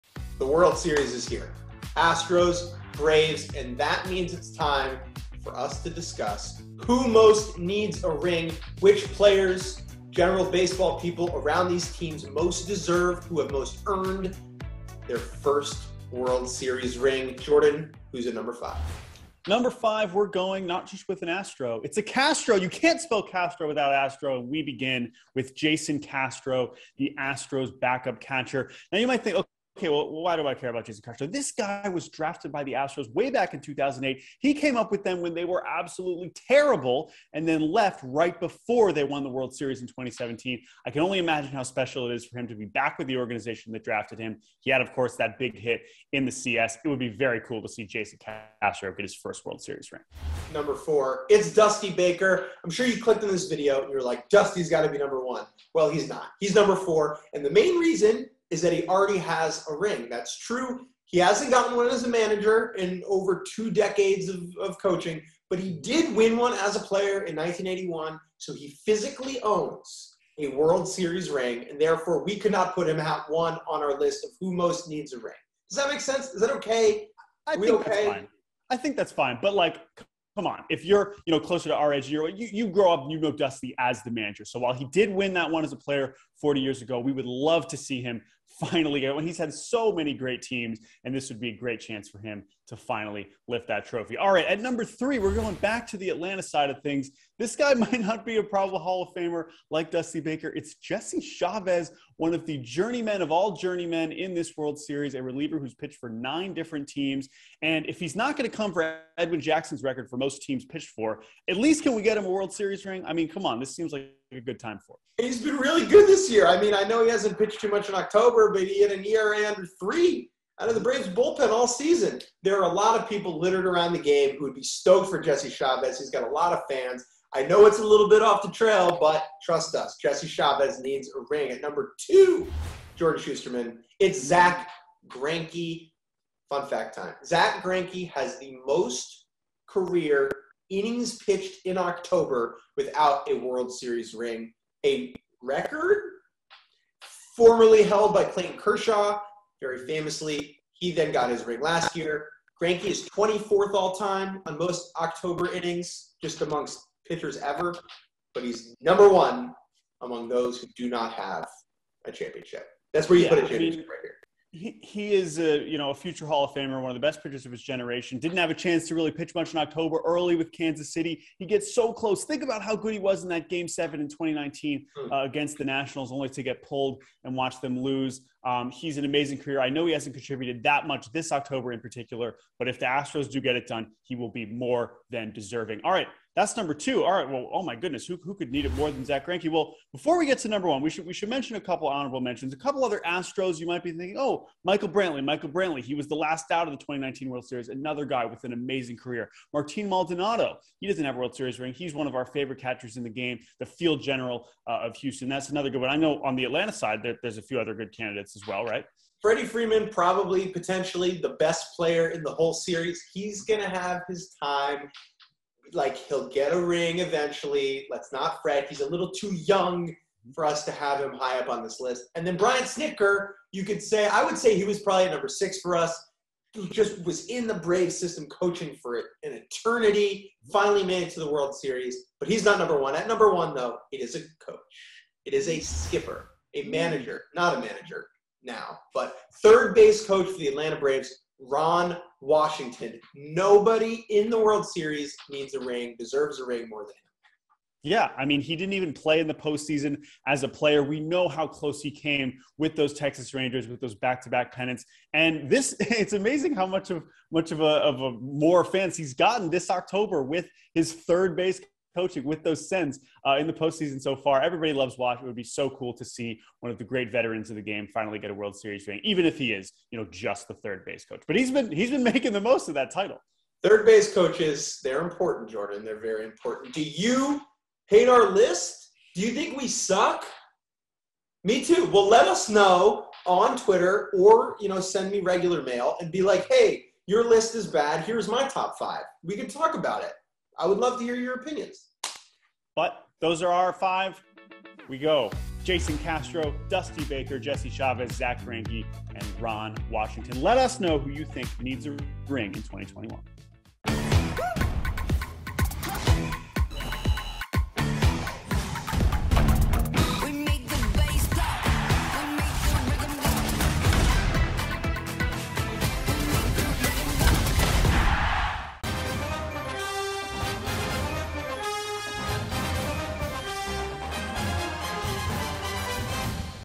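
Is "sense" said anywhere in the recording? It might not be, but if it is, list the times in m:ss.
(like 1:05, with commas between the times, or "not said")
1:16.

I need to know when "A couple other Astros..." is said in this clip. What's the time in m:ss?
3:12.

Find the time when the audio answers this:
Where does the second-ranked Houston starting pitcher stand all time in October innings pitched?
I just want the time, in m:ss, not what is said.
2:33.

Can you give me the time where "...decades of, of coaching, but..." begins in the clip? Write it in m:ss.
1:03.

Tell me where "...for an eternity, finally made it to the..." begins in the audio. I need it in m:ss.
3:48.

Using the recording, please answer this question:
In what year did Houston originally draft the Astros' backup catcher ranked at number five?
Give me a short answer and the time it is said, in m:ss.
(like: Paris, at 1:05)
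2008, at 0:33.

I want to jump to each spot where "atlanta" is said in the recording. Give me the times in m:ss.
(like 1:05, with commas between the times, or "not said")
1:36, 3:26, 4:00.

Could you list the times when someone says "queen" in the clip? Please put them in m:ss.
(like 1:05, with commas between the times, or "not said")
not said.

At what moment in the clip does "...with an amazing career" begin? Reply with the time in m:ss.
3:18.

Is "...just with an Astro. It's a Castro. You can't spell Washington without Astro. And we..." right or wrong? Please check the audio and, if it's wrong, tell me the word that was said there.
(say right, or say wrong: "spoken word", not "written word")
wrong: "Castro", not "Washington".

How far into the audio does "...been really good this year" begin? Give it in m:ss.
1:55.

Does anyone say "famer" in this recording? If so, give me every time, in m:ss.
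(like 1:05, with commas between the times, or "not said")
1:39, 2:46.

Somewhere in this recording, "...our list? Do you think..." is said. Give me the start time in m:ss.
4:38.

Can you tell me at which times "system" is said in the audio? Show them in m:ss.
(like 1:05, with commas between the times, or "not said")
3:47.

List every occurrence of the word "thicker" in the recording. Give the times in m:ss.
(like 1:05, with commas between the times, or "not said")
not said.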